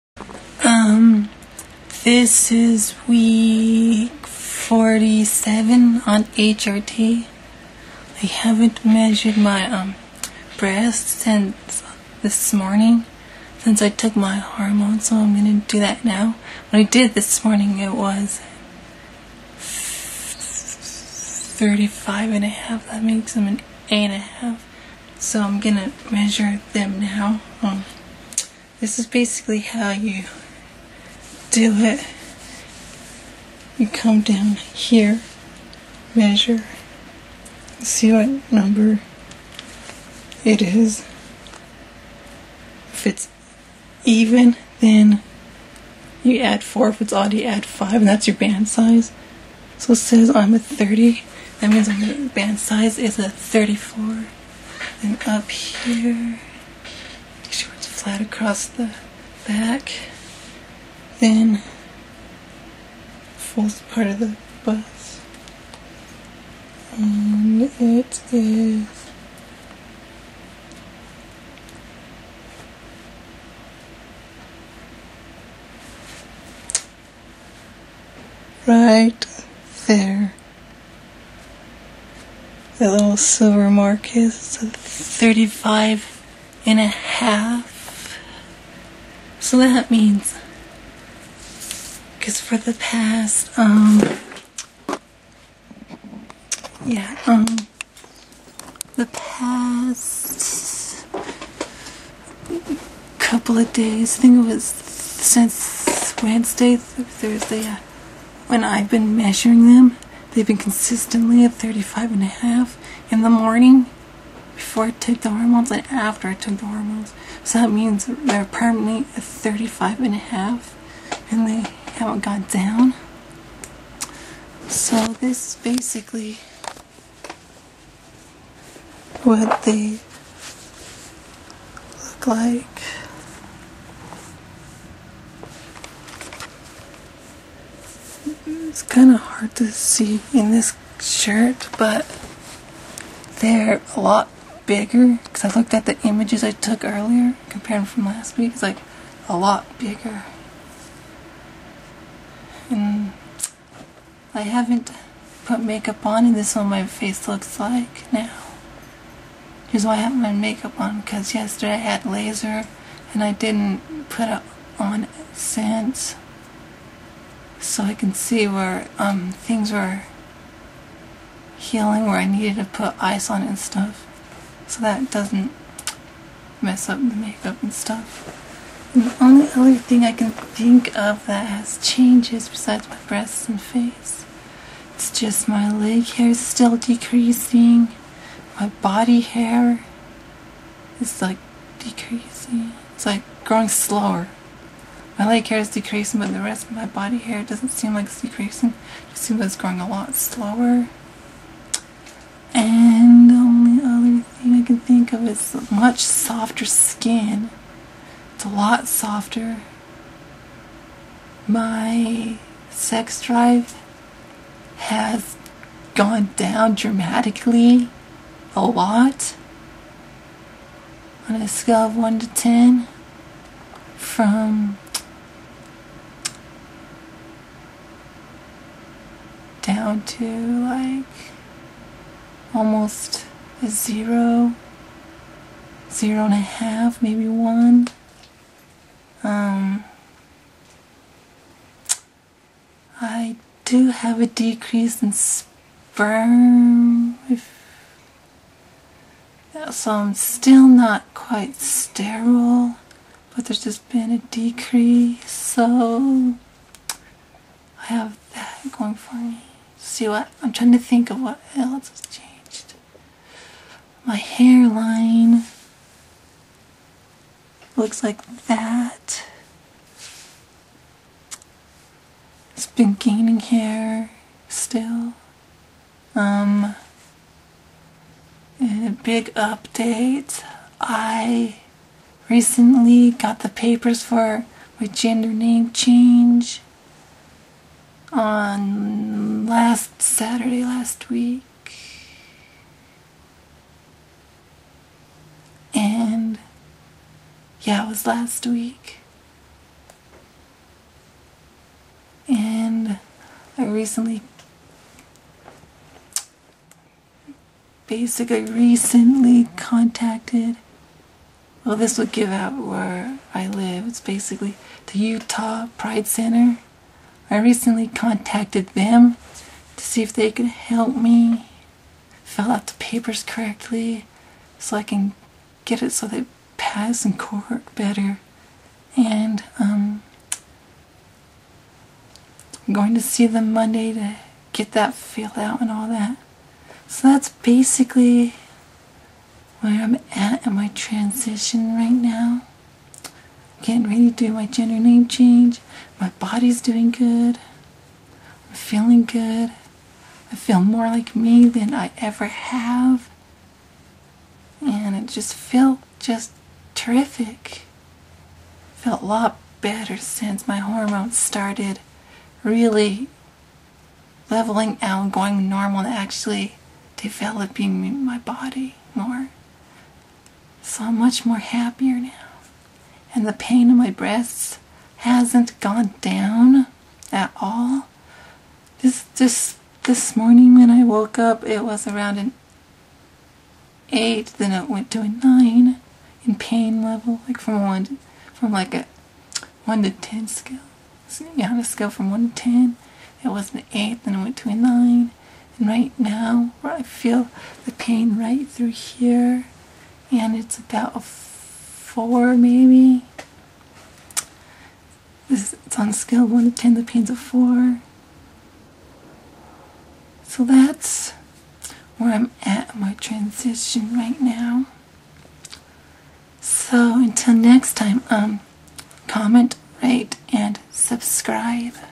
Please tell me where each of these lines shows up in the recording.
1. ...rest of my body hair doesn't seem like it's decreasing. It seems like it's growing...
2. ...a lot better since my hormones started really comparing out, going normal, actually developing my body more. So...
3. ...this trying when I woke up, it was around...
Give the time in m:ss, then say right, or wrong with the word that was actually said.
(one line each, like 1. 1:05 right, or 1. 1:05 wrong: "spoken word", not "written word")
1. 3:16 right
2. 5:59 wrong: "leveling", not "comparing"
3. 6:19 wrong: "morning", not "trying".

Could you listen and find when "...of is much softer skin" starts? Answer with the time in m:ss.
3:25.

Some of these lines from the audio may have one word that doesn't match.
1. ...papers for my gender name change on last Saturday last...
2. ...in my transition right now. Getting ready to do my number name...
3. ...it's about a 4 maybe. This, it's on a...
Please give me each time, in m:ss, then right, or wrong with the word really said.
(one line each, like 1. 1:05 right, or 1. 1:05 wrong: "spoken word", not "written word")
1. 4:43 right
2. 5:40 wrong: "gender", not "number"
3. 6:40 right.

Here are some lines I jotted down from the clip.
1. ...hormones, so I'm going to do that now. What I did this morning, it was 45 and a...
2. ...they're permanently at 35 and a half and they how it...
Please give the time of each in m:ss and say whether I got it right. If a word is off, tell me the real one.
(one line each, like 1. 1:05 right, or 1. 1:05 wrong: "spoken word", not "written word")
1. 0:14 wrong: "35", not "45"
2. 1:58 right.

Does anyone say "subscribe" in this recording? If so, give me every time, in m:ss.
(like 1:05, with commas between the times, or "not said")
7:00.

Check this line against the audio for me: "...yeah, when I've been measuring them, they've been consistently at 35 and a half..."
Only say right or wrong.
right.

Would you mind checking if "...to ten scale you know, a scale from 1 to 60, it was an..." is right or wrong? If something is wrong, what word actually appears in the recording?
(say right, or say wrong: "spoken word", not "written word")
wrong: "10", not "60".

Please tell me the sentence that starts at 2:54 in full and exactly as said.
So that doesn't mess up the makeup and stuff.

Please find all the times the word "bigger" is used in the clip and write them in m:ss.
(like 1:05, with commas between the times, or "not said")
2:24, 2:29.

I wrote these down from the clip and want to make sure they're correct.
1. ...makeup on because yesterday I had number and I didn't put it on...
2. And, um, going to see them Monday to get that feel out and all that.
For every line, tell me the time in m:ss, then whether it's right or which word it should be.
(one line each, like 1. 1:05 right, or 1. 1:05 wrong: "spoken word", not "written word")
1. 2:40 wrong: "laser", not "number"
2. 5:28 right.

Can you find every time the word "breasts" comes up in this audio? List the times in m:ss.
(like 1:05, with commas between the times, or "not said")
0:10, 3:03, 6:13.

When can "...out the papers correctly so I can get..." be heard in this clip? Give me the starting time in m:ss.
5:22.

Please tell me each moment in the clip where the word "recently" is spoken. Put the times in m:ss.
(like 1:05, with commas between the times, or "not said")
4:42, 5:03, 5:08, 5:17.